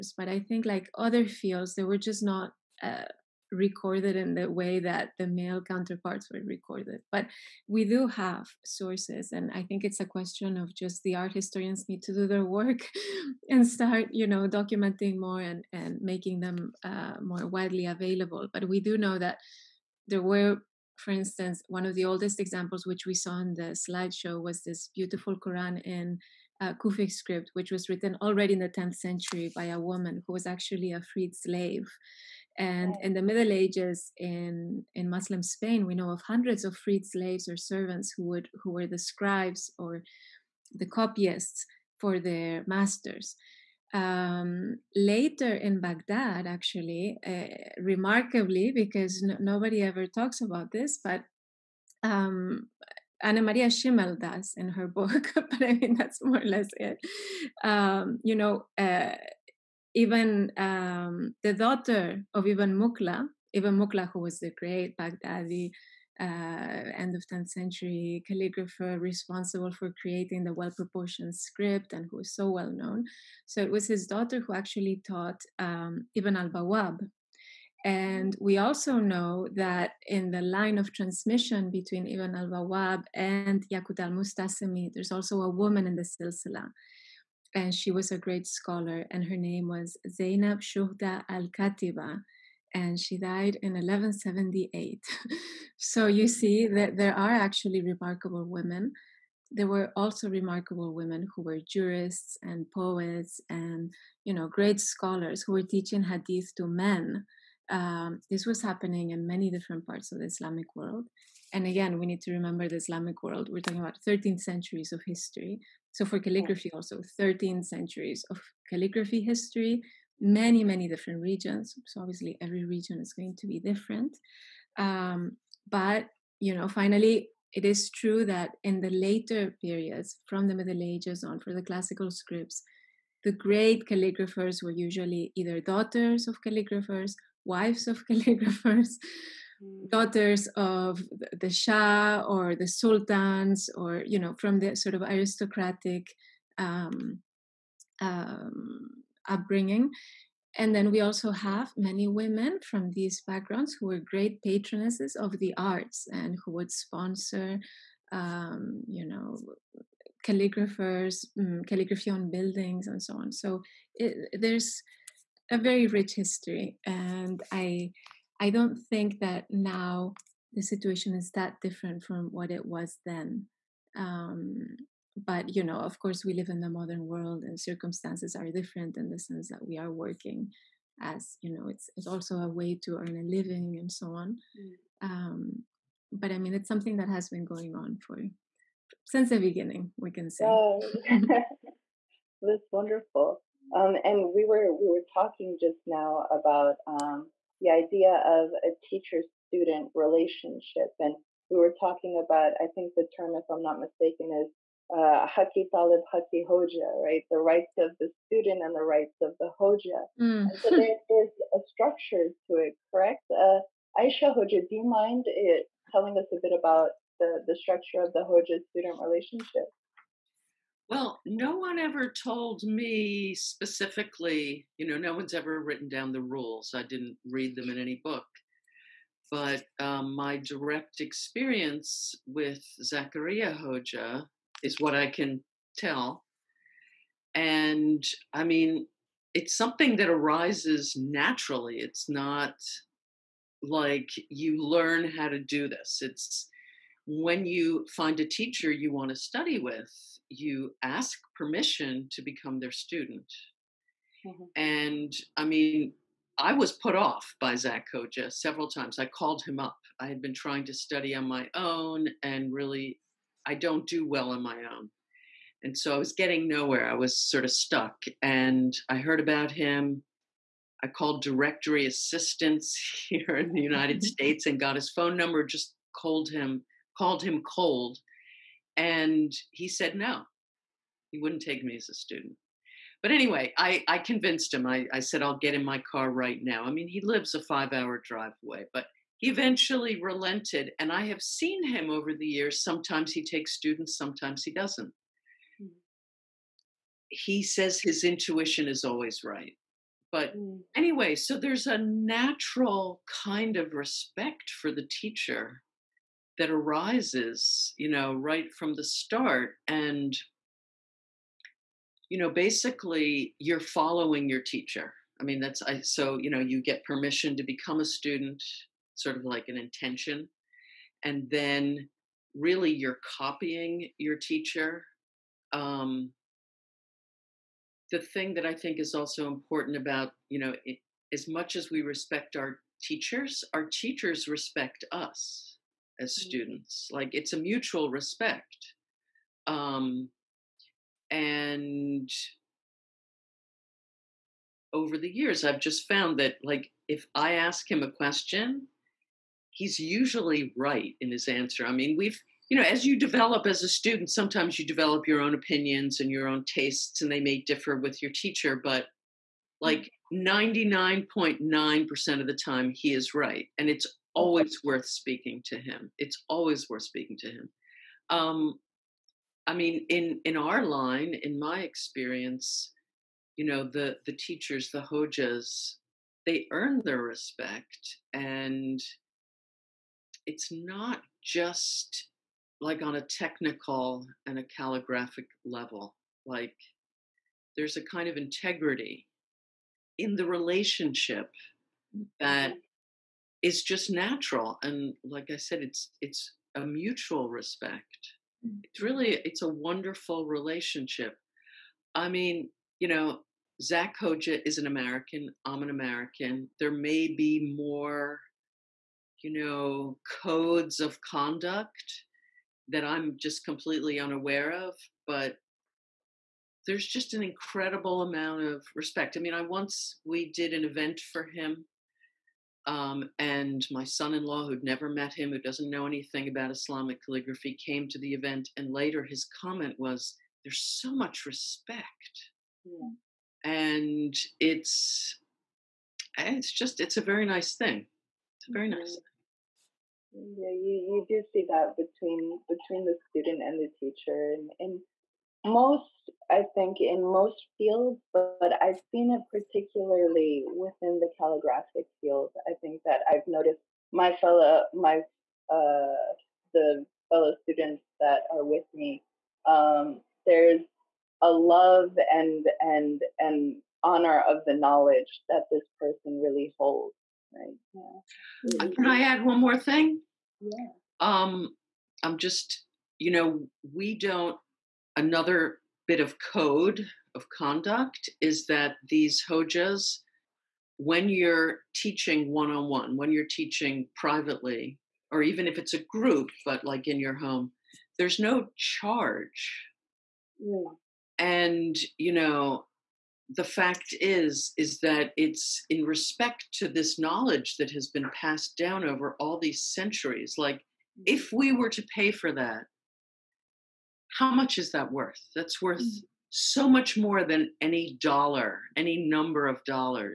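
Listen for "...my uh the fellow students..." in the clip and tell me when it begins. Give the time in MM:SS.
07:34.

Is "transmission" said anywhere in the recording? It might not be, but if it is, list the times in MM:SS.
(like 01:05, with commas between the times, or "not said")
01:20.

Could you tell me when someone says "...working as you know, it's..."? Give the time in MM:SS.
02:59.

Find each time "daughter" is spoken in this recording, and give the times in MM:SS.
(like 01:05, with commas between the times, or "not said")
01:01, 01:14, 02:15, 02:19.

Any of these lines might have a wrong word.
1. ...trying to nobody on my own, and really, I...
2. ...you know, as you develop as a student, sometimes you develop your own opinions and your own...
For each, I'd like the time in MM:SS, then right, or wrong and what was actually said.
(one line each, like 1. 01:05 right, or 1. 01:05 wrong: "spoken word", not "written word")
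1. 04:20 wrong: "study", not "nobody"
2. 05:52 right.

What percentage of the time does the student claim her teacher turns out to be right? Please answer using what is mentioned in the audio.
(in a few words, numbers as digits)
99.9%.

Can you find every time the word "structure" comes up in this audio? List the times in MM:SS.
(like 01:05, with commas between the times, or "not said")
03:31, 03:37.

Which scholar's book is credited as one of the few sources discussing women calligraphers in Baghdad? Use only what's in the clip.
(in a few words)
Annemarie Schimmel.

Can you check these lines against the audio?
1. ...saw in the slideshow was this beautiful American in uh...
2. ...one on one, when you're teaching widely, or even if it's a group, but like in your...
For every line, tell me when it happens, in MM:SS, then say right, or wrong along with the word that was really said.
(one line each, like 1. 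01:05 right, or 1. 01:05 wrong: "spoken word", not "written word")
1. 00:23 wrong: "Quran", not "American"
2. 08:02 wrong: "privately", not "widely".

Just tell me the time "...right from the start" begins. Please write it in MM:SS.
05:08.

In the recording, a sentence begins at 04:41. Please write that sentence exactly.
He wouldn't take me as a student.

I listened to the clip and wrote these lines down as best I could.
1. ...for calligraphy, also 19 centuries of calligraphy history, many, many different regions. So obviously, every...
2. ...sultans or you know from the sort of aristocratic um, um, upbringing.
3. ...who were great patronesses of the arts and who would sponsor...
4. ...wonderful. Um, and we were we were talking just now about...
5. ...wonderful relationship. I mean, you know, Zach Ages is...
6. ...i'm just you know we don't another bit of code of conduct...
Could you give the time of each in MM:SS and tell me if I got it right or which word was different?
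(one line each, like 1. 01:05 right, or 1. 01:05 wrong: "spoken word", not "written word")
1. 01:56 wrong: "13", not "19"
2. 02:22 right
3. 02:33 right
4. 03:12 right
5. 06:39 wrong: "Hoja", not "Ages"
6. 07:52 right.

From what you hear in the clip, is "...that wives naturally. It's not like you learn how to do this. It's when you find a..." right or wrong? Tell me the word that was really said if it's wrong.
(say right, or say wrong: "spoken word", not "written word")
wrong: "arises", not "wives".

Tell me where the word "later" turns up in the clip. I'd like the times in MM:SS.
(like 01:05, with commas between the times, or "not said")
00:44, 02:08, 07:08.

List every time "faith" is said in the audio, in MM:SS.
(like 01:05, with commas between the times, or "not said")
not said.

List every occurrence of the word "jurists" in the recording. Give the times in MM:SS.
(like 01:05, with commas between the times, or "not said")
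01:41.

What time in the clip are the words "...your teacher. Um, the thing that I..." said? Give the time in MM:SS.
05:23.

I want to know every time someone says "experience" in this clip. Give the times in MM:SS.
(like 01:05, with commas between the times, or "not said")
03:50, 06:11.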